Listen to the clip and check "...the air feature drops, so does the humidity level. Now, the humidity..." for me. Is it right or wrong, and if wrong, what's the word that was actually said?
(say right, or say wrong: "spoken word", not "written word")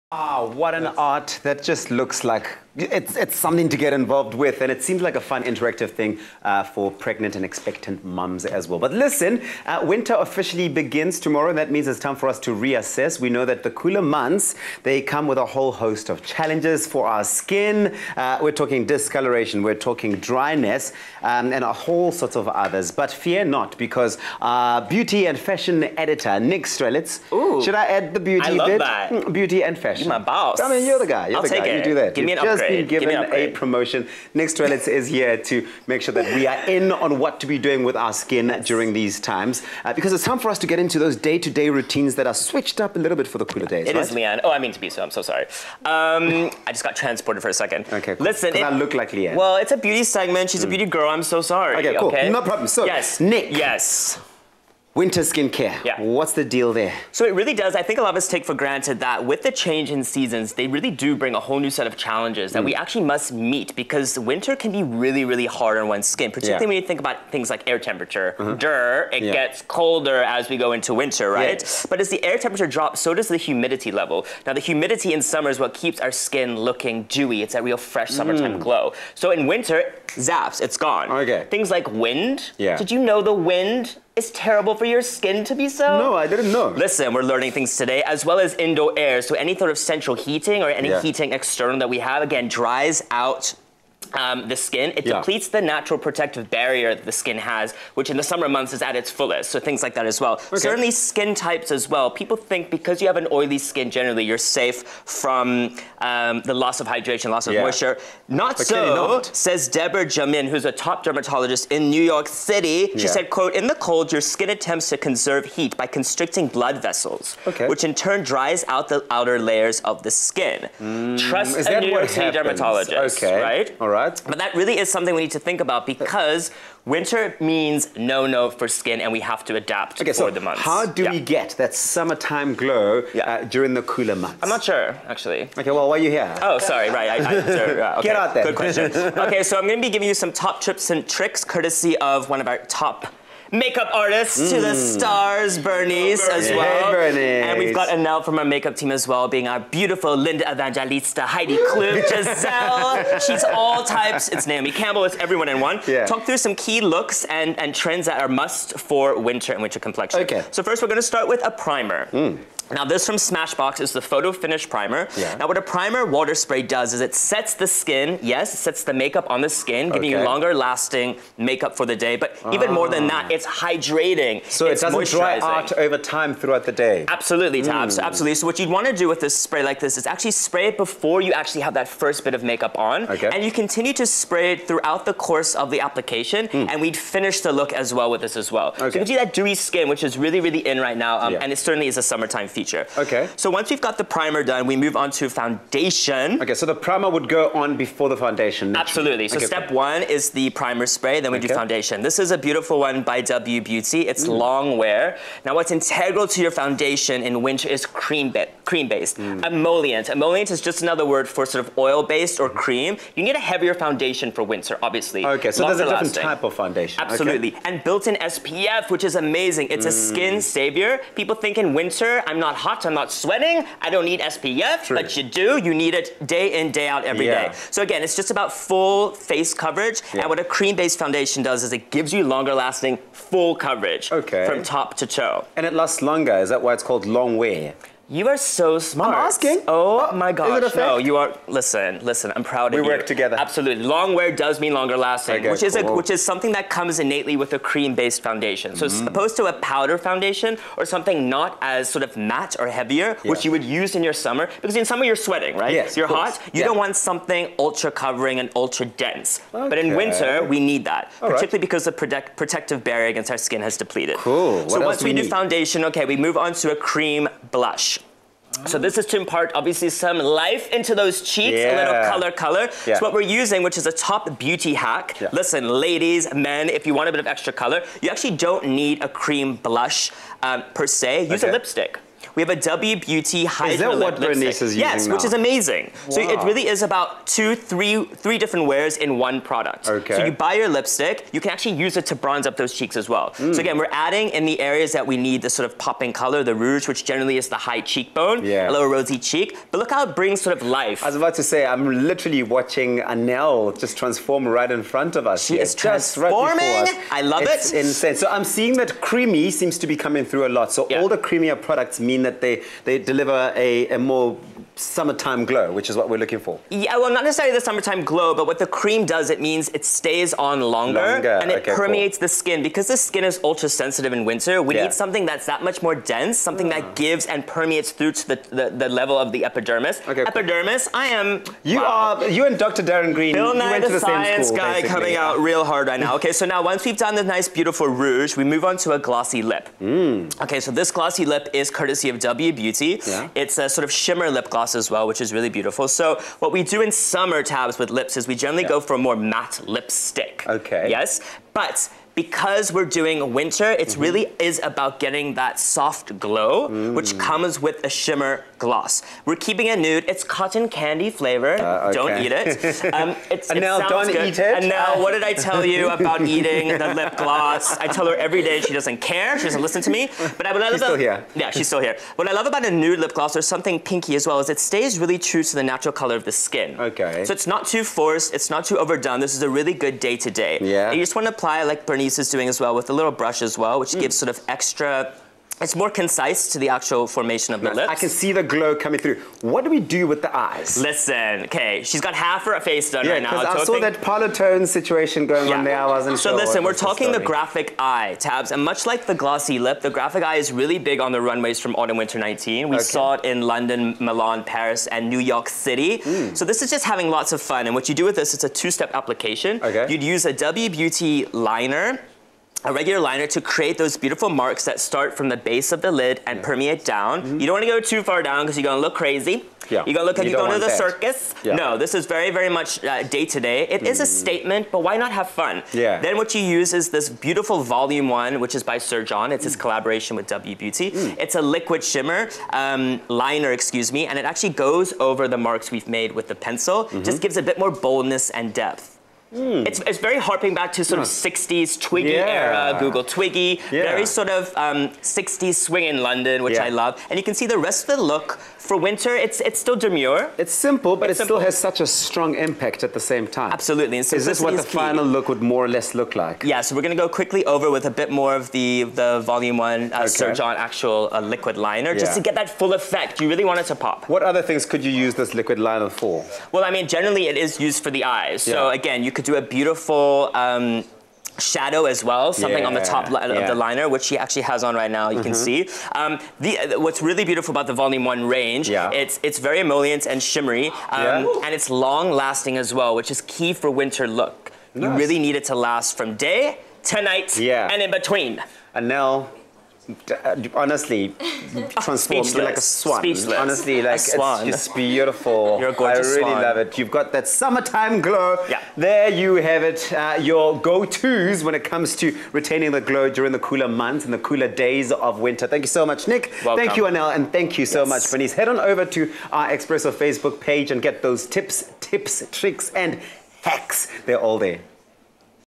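wrong: "temperature", not "feature".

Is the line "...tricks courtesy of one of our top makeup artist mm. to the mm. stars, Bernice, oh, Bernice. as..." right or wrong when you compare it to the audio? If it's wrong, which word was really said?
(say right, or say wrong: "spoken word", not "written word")
right.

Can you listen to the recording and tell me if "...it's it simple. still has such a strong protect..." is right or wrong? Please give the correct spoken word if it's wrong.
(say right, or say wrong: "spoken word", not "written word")
wrong: "impact", not "protect".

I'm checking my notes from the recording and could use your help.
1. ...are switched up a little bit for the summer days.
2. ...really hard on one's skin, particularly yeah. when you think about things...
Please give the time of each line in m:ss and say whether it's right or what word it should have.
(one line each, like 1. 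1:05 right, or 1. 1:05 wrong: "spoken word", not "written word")
1. 0:42 wrong: "cooler", not "summer"
2. 1:05 right.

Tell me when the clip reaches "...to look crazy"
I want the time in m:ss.
6:58.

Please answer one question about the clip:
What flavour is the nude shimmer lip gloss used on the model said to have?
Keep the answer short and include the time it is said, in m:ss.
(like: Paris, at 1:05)
cotton candy, at 6:00.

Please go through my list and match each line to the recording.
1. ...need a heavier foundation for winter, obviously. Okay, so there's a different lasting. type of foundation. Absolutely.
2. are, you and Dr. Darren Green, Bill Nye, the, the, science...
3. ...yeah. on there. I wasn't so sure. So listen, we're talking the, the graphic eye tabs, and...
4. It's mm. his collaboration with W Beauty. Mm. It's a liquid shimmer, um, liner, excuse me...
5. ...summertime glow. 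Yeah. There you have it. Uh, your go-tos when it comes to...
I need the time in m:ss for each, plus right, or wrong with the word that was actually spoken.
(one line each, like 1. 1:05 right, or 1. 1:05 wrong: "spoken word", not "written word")
1. 3:33 right
2. 5:32 right
3. 6:35 right
4. 7:09 right
5. 8:17 right.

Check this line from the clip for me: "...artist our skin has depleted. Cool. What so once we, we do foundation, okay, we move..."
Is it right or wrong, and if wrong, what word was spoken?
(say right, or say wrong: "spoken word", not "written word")
wrong: "against", not "artist".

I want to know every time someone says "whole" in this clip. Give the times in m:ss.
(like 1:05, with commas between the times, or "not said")
0:15, 0:21, 1:01.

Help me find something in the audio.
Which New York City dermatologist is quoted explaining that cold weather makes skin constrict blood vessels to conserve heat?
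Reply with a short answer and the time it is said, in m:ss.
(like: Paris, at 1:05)
Deborah Jaliman, at 1:49.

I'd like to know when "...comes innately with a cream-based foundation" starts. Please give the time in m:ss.
4:06.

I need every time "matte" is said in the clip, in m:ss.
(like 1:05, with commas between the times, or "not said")
4:12, 5:49.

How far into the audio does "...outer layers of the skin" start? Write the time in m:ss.
1:59.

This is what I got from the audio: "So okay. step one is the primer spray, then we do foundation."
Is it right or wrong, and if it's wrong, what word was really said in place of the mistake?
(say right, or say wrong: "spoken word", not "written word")
right.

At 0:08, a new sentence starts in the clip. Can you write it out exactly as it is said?
But listen, uh, winter officially begins tomorrow.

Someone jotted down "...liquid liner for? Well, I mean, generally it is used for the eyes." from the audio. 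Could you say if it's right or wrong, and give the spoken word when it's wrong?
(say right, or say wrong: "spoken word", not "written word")
right.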